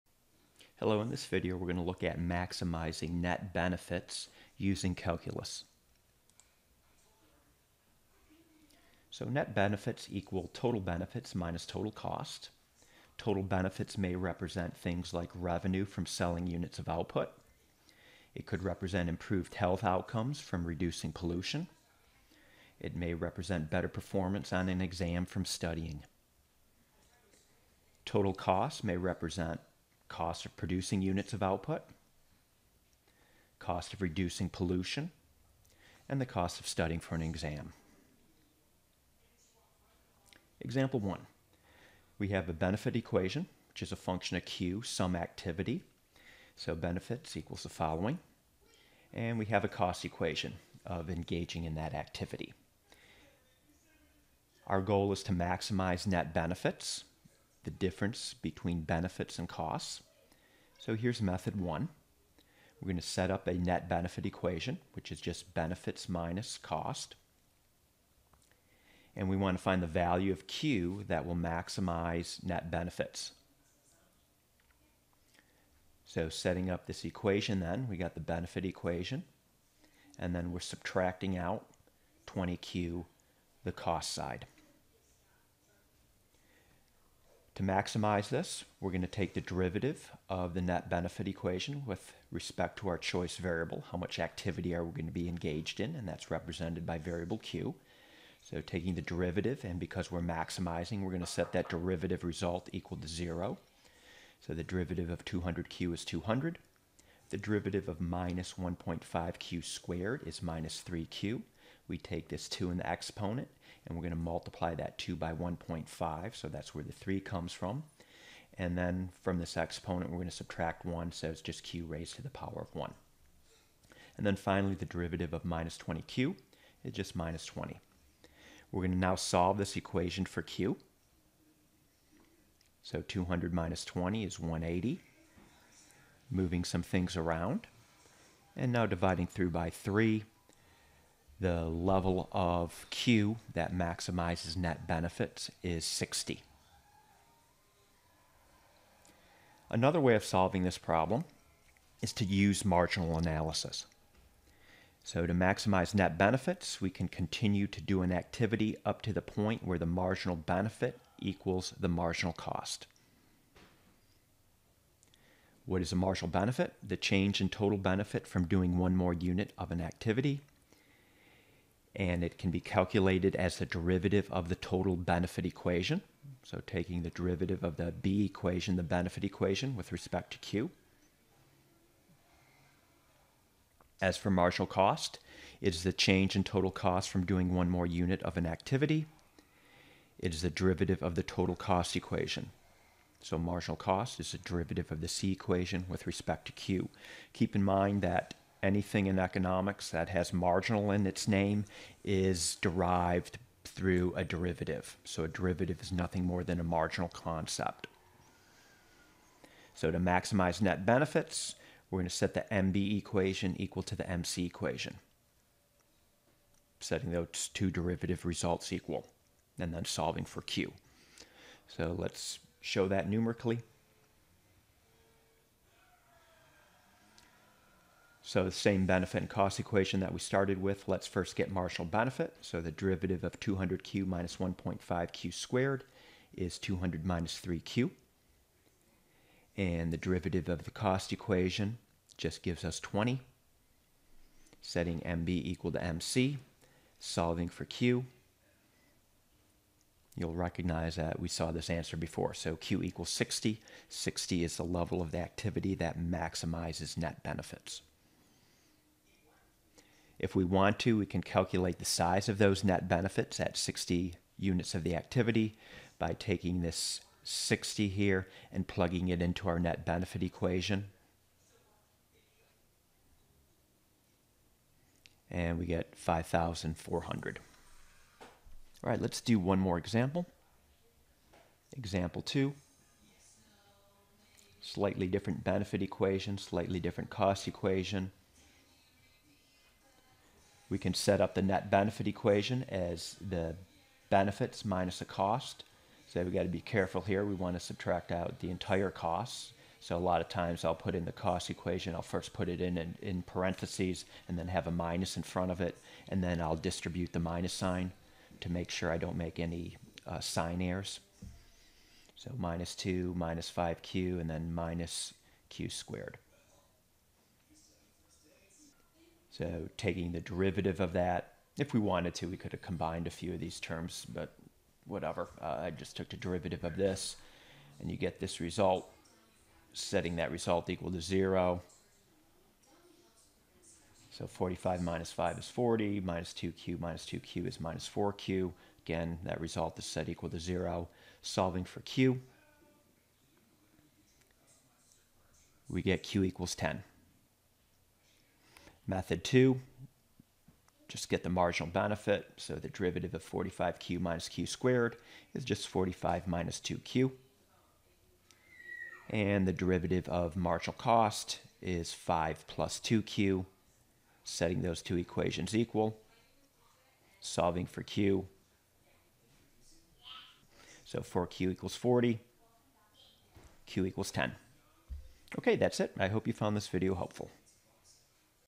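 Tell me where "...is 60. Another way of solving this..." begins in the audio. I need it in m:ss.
2:25.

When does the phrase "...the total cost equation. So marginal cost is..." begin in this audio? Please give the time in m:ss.
3:11.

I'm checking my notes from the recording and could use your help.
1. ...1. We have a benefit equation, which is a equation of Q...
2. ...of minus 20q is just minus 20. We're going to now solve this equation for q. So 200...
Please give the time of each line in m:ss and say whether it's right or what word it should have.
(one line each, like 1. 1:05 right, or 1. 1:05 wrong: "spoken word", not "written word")
1. 0:40 wrong: "function", not "equation"
2. 2:05 right.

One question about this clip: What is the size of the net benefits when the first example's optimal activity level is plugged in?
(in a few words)
5,400.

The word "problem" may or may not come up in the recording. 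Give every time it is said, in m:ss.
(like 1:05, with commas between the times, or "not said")
2:30.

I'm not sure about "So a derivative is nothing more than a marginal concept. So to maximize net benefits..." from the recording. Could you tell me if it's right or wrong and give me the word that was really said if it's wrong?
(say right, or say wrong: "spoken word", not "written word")
right.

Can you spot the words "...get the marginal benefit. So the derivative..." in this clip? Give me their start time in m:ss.
5:51.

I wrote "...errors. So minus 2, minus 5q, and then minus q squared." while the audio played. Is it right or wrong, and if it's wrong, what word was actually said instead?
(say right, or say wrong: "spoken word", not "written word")
right.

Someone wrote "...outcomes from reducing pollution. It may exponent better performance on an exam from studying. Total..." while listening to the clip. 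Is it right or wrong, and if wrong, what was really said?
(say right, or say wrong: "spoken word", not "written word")
wrong: "represent", not "exponent".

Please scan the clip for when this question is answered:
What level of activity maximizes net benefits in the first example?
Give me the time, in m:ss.
2:21.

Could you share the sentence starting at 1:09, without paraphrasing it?
And we want to find the value of Q that will maximize net benefits.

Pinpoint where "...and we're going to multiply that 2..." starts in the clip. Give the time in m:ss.
1:53.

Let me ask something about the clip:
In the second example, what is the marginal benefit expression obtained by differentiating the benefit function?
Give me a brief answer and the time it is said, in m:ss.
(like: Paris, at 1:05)
45 - 2q, at 5:55.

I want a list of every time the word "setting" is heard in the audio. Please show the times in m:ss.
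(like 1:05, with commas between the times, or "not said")
1:16, 3:36, 4:04, 5:29, 6:04.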